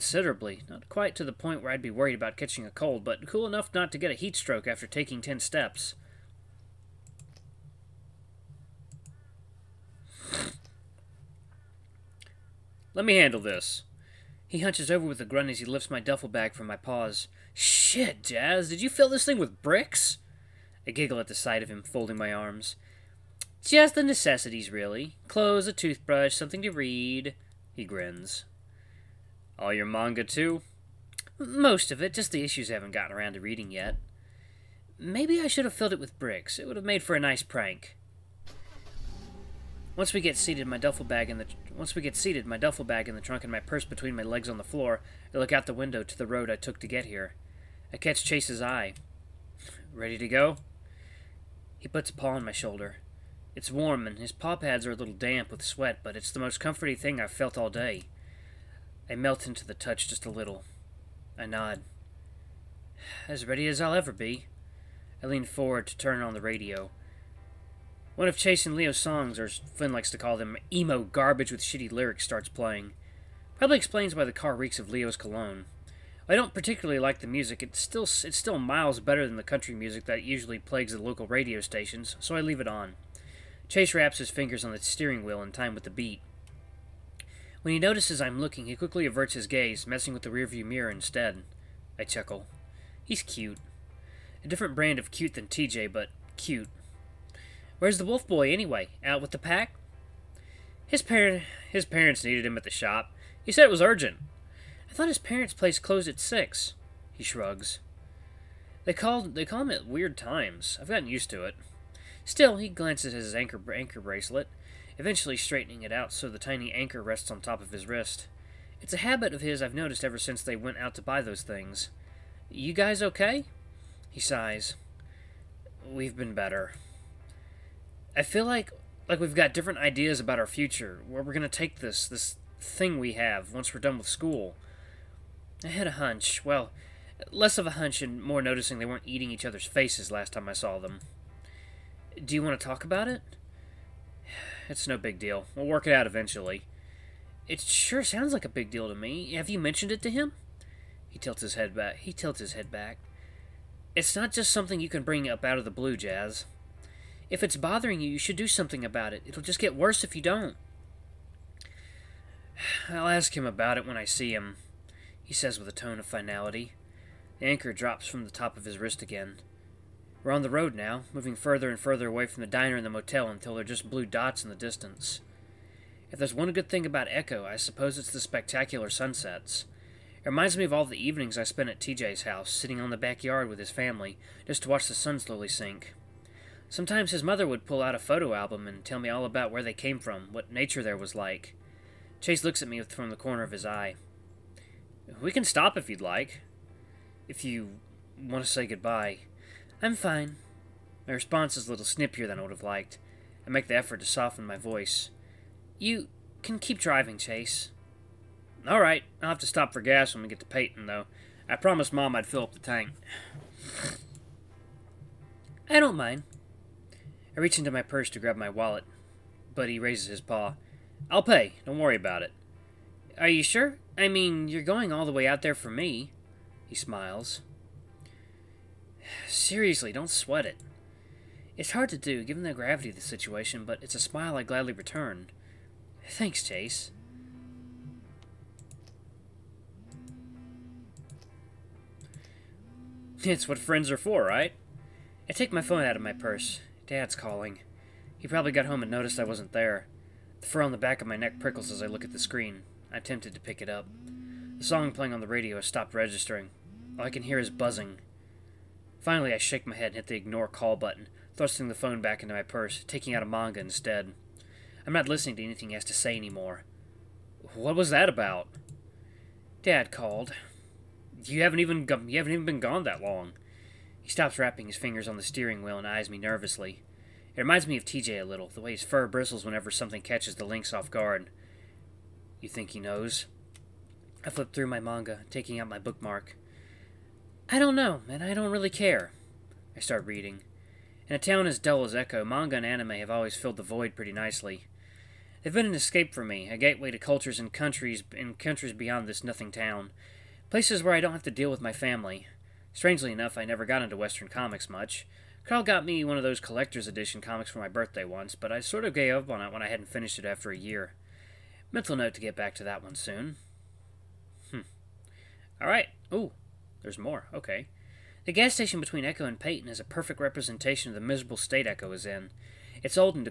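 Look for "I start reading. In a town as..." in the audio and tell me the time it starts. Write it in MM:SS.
04:49.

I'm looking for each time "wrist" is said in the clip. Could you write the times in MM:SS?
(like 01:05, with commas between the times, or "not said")
01:57, 02:48.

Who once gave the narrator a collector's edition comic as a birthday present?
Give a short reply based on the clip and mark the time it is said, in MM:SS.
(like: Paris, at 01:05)
Carl, at 05:05.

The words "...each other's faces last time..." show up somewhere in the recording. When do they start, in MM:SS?
02:19.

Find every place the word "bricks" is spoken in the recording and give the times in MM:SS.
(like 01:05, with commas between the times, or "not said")
00:19, 00:36.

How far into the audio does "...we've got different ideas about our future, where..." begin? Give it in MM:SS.
02:09.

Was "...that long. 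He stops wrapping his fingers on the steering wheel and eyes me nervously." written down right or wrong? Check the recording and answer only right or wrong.
right.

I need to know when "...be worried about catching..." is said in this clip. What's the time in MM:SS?
00:01.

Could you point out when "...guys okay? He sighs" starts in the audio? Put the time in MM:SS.
02:02.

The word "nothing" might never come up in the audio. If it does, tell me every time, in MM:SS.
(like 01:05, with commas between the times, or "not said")
04:59.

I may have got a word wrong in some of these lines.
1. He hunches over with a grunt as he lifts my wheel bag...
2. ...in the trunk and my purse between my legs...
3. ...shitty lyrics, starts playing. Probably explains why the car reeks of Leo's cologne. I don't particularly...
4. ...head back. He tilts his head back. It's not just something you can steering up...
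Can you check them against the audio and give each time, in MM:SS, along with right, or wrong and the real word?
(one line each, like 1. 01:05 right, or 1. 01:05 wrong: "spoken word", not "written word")
1. 00:14 wrong: "duffel", not "wheel"
2. 00:43 right
3. 01:11 right
4. 02:31 wrong: "bring", not "steering".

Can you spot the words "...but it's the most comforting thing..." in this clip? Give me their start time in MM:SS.
00:56.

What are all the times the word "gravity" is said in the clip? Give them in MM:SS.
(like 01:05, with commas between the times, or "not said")
03:52.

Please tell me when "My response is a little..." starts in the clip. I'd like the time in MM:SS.
03:21.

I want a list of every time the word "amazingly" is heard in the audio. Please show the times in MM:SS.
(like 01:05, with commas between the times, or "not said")
not said.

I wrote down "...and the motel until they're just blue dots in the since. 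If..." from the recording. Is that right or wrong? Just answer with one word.
wrong.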